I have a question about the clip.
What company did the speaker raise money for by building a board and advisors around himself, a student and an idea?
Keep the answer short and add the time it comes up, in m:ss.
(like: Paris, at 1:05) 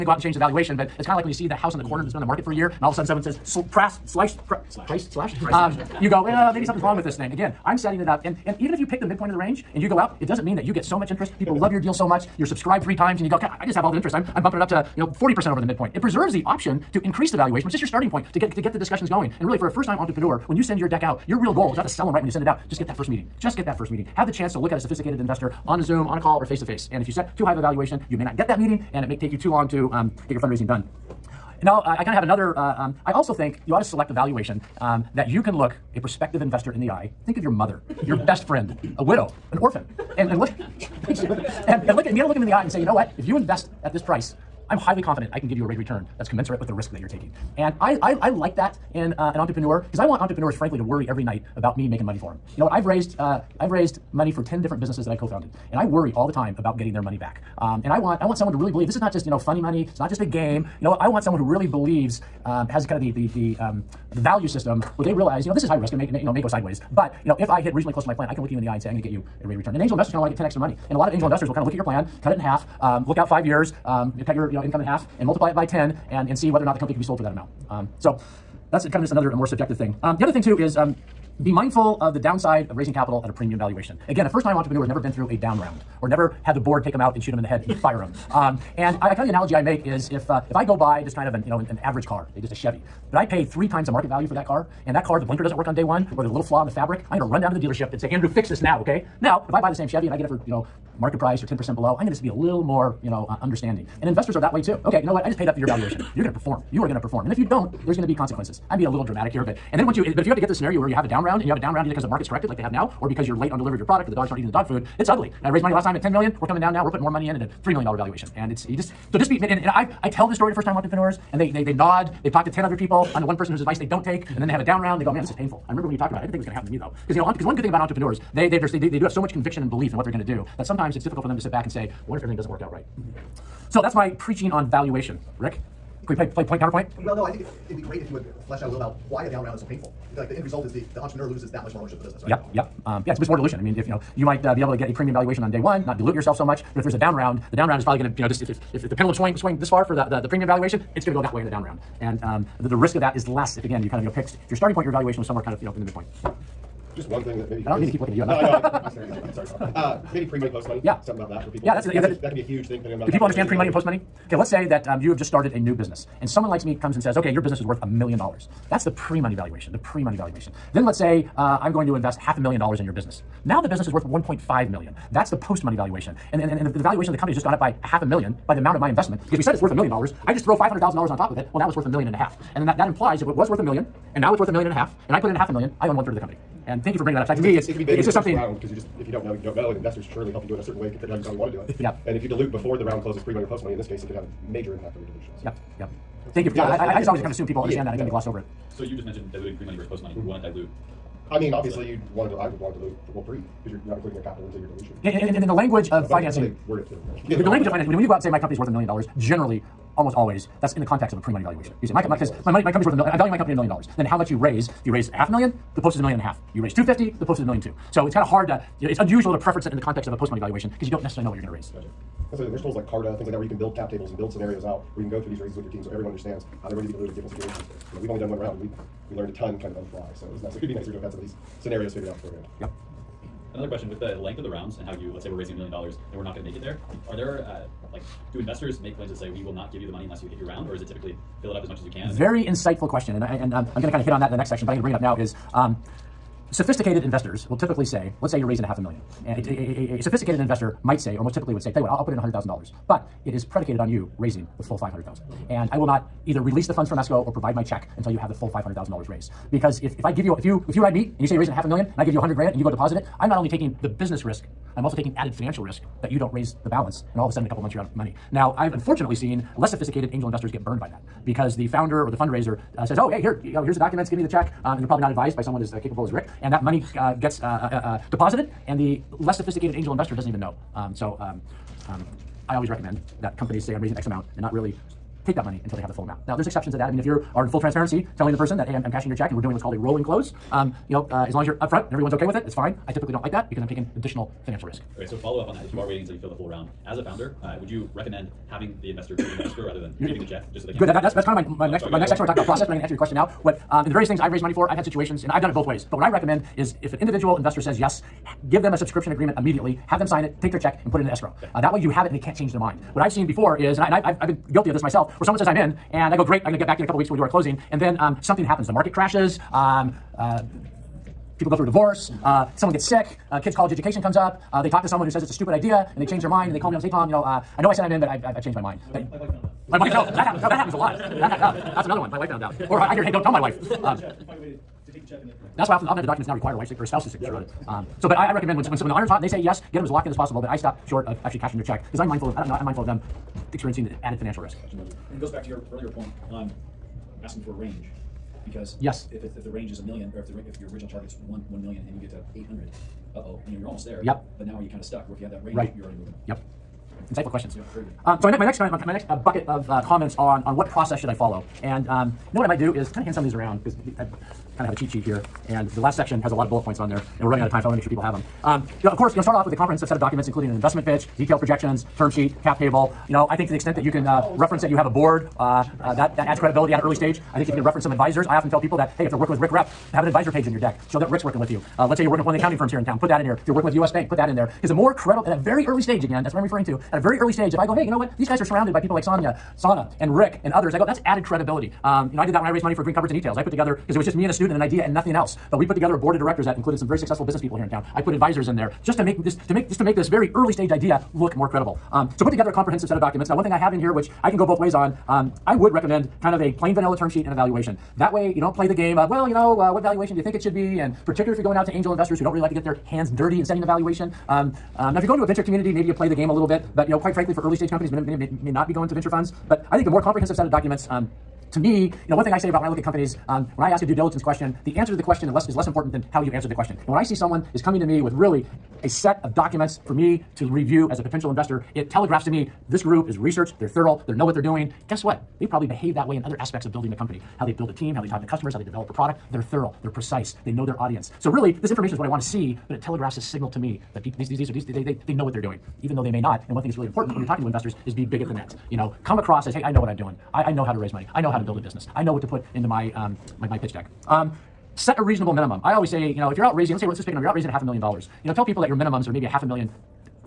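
Green Cupboards, at 6:32.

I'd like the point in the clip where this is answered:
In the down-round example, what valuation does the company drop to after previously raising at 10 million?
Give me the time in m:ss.
1:57.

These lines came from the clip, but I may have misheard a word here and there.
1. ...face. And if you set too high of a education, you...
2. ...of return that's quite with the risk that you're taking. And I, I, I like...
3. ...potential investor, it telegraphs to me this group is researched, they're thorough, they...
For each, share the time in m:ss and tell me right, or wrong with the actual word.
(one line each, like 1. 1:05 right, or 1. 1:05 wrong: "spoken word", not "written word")
1. 0:26 wrong: "valuation", not "education"
2. 0:45 wrong: "commensurate", not "quite"
3. 7:11 right.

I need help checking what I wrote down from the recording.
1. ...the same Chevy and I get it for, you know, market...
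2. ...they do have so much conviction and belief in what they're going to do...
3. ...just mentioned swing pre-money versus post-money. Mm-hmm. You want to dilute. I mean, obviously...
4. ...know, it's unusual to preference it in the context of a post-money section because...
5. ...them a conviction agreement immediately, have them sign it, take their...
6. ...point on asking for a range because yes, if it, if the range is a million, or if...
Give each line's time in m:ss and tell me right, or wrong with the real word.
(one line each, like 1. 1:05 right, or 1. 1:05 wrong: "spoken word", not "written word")
1. 1:39 right
2. 2:08 right
3. 3:18 wrong: "diluting", not "swing"
4. 3:38 wrong: "valuation", not "section"
5. 5:08 wrong: "subscription", not "conviction"
6. 5:45 right.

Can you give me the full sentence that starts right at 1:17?
Um, so, that's kind of just another more subjective thing.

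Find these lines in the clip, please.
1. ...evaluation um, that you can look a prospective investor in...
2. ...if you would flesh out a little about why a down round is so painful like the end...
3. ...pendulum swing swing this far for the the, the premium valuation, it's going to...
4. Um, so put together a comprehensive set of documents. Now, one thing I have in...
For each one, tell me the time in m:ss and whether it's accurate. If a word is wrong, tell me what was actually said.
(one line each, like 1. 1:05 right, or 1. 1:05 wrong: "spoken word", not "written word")
1. 0:34 wrong: "valuation", not "evaluation"
2. 2:17 right
3. 2:28 right
4. 6:41 right.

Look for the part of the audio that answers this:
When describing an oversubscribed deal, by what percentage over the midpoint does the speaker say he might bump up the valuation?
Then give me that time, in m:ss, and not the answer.
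0:15.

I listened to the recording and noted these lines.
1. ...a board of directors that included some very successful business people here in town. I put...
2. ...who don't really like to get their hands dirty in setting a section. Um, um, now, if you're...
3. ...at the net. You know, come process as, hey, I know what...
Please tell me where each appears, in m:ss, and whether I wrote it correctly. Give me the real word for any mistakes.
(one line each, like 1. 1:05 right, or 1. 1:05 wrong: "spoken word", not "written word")
1. 6:35 right
2. 6:52 wrong: "valuation", not "section"
3. 7:28 wrong: "across", not "process".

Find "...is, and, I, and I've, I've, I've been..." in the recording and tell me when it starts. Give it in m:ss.
5:13.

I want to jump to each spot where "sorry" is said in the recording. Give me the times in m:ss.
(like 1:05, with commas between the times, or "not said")
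2:39, 5:01.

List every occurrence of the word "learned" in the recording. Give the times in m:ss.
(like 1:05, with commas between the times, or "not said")
3:49.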